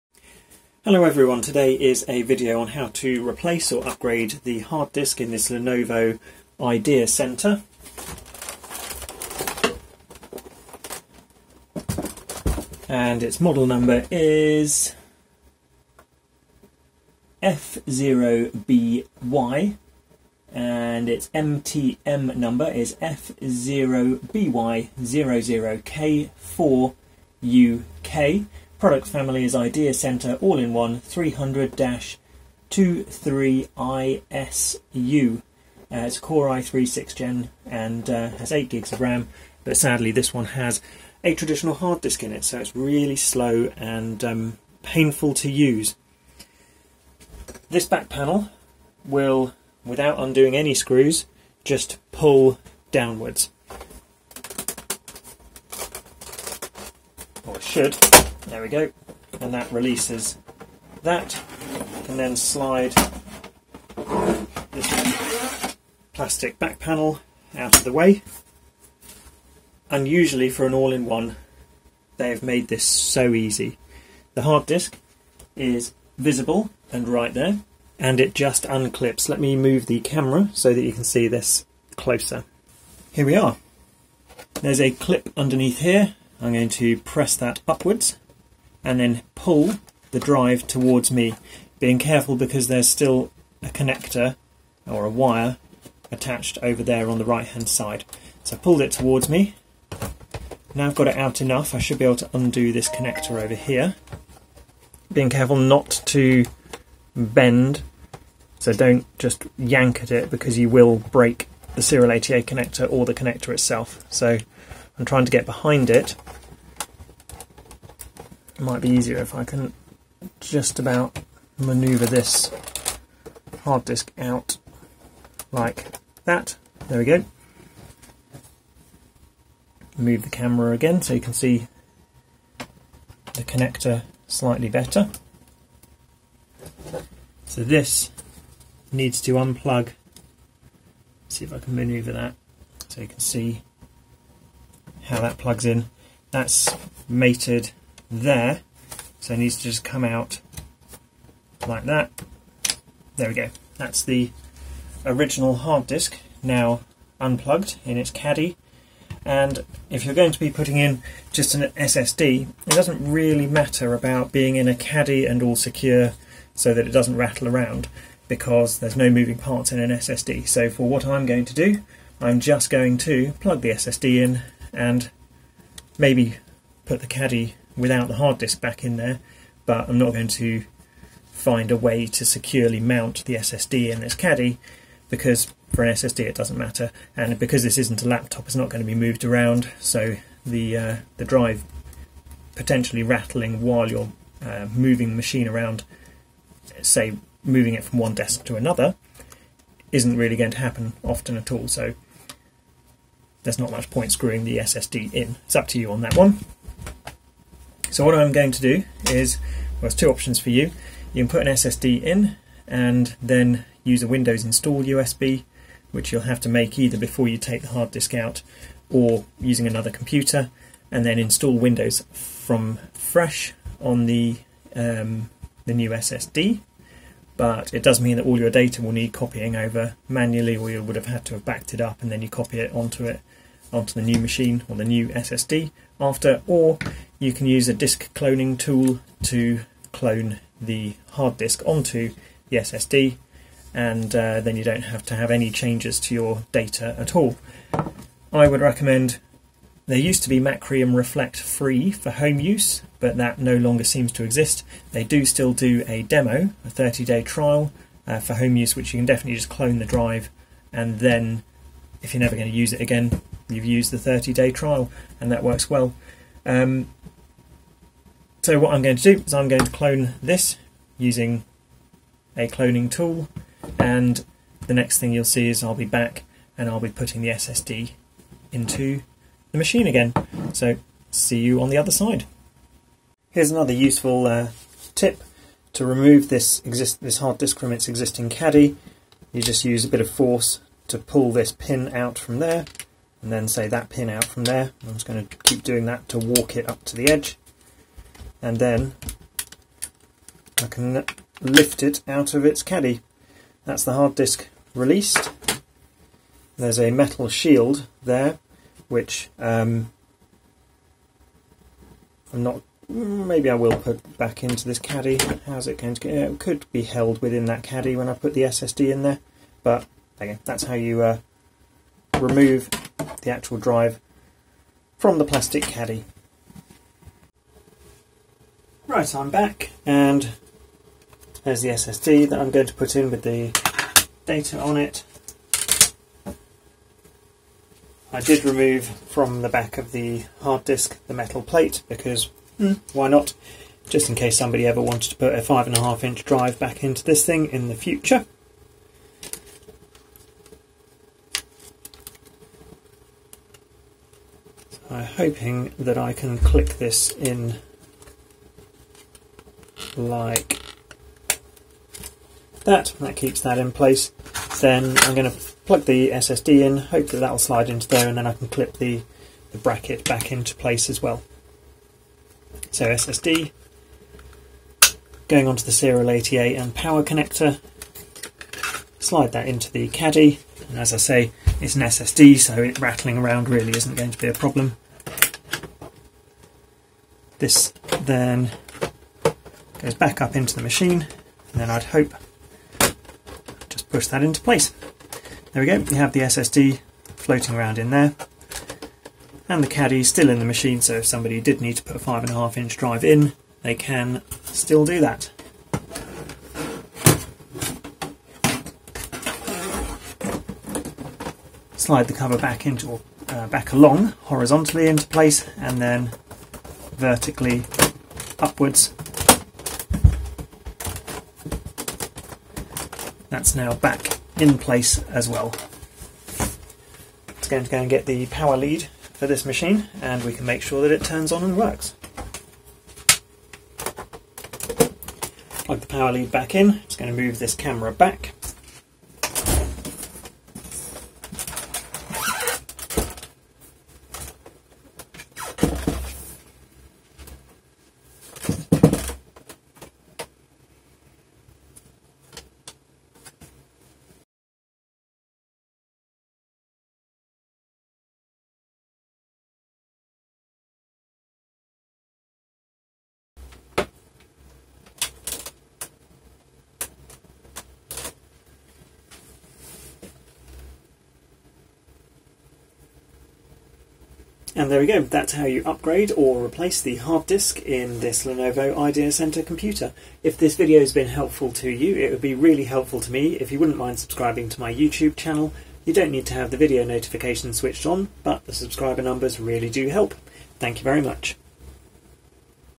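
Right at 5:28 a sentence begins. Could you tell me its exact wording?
Right, I'm back and there's the SSD that I'm going to put in with the data on it.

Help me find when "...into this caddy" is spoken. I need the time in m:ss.
5:14.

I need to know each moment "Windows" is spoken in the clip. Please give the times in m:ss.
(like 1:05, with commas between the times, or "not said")
3:34, 3:41.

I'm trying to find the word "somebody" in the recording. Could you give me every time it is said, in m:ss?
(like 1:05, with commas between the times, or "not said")
5:44, 6:41.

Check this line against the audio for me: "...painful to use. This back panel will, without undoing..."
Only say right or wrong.
right.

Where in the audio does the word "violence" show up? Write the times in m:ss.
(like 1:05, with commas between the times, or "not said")
not said.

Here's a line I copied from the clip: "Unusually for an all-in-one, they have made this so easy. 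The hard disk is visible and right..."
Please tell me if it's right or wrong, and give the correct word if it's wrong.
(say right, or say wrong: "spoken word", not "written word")
right.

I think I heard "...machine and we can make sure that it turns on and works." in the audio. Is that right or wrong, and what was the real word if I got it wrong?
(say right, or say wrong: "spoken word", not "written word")
right.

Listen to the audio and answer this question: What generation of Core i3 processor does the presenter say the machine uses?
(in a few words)
six gen.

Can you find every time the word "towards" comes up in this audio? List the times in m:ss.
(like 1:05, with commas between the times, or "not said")
1:30, 1:38.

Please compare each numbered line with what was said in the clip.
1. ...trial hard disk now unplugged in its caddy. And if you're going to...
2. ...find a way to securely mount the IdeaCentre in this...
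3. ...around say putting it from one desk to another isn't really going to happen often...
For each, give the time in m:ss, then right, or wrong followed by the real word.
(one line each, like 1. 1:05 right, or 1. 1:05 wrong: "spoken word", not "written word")
1. 2:35 wrong: "original", not "trial"
2. 3:01 wrong: "SSD", not "IdeaCentre"
3. 3:15 wrong: "moving", not "putting".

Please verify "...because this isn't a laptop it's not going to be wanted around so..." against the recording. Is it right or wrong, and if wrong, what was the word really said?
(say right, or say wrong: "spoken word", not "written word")
wrong: "moved", not "wanted".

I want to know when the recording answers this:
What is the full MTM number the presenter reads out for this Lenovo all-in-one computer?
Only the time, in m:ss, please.
0:22.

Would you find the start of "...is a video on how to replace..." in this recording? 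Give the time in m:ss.
0:01.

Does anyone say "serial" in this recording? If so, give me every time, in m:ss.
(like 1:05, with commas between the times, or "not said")
1:51, 6:15.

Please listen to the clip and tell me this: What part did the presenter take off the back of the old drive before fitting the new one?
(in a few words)
metal plate.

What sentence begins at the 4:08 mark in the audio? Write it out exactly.
I would recommend there used to be Macrium Reflect free for home use, but that no longer seems to exist.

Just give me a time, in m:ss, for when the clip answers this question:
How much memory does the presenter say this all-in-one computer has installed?
0:38.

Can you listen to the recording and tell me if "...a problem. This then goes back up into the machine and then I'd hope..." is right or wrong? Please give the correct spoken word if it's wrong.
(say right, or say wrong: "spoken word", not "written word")
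right.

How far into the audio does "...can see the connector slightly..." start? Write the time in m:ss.
2:11.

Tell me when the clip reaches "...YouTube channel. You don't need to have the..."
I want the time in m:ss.
8:04.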